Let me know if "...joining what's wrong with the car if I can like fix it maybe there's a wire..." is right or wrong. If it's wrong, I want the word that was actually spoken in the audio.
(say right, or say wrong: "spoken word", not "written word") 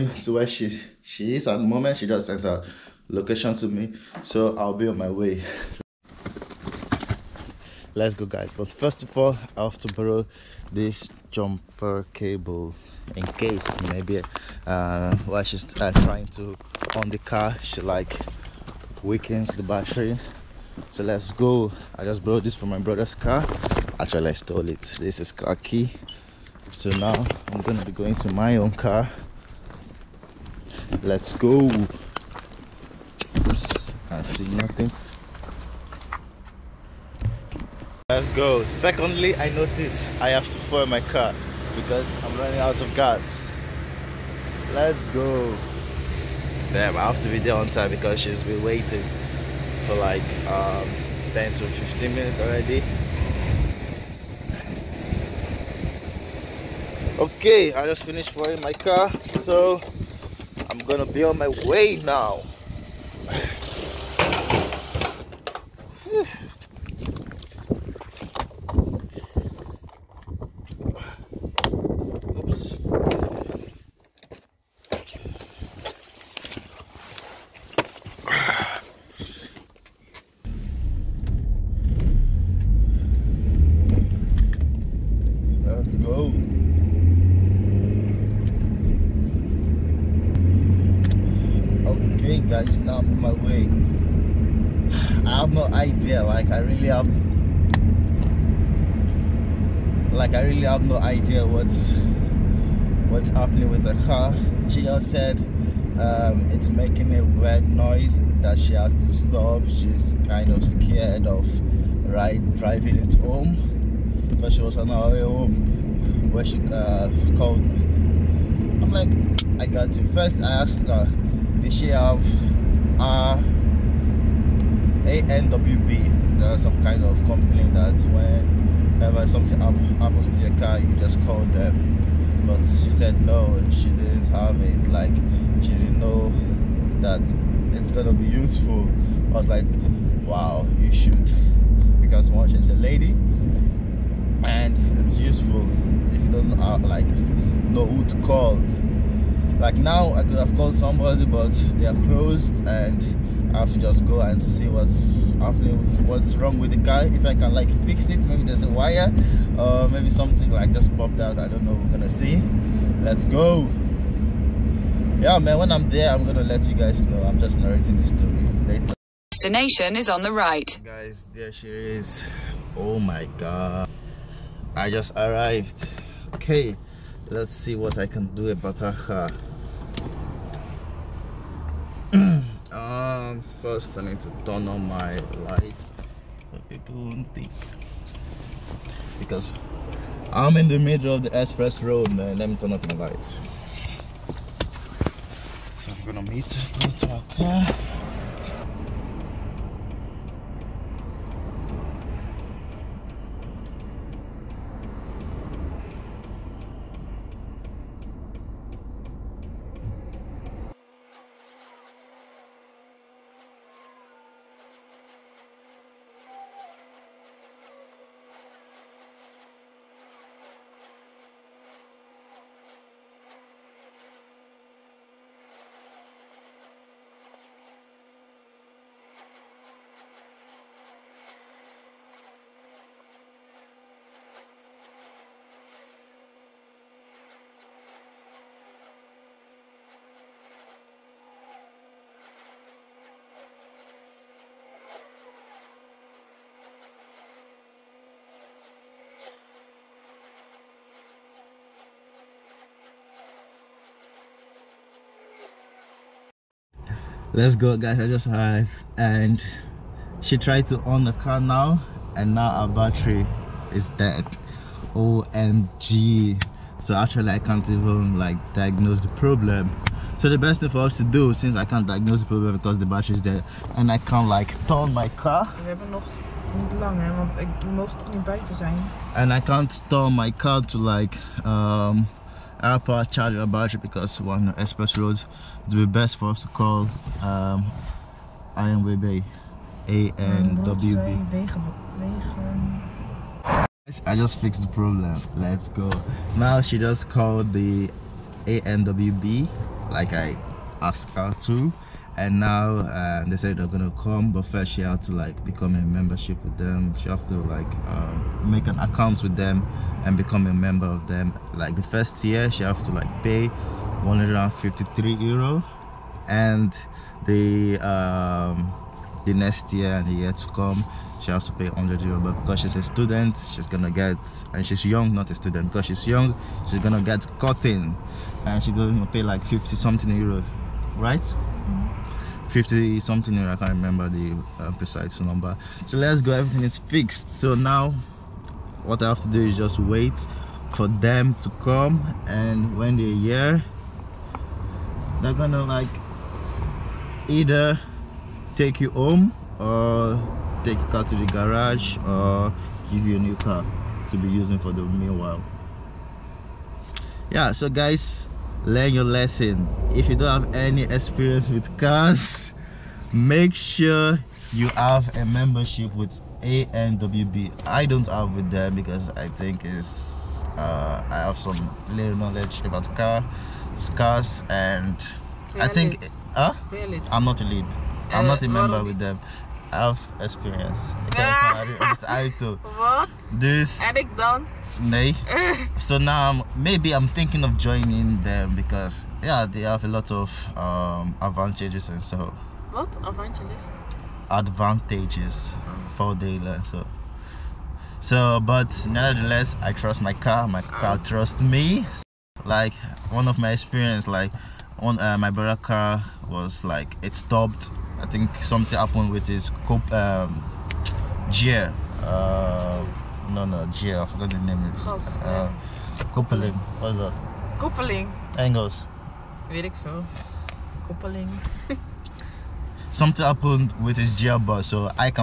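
wrong: "happening", not "joining".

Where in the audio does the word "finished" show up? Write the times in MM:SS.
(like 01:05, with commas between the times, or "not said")
00:58.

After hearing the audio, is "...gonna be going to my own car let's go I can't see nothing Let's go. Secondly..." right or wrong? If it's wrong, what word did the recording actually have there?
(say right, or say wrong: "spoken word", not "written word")
right.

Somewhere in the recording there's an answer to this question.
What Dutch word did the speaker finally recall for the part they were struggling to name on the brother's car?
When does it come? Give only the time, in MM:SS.
07:00.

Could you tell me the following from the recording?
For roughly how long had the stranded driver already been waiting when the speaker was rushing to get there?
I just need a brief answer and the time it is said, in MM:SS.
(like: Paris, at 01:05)
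10 to 15 minutes, at 00:51.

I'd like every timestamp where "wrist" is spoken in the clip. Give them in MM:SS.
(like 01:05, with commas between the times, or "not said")
not said.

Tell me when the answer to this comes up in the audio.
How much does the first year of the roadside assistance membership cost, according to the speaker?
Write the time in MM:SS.
05:14.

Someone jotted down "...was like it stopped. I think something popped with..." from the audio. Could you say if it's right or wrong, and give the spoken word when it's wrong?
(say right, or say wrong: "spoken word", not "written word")
wrong: "happened", not "popped".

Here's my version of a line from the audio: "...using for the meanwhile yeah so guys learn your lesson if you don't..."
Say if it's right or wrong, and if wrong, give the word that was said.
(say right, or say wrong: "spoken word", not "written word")
right.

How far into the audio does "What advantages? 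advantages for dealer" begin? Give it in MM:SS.
06:32.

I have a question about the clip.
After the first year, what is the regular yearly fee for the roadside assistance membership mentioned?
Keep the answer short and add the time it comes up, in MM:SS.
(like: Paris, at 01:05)
100 euro, at 05:21.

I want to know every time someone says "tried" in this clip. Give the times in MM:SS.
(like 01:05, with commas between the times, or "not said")
04:20.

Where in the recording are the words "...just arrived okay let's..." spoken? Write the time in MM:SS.
02:54.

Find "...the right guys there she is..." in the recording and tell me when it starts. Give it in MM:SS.
02:50.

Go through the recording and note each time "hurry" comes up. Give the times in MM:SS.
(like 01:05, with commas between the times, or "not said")
not said.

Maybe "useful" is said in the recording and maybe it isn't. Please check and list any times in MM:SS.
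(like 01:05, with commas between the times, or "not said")
02:18, 02:25.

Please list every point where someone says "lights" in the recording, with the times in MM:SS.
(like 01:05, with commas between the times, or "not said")
03:05, 03:12.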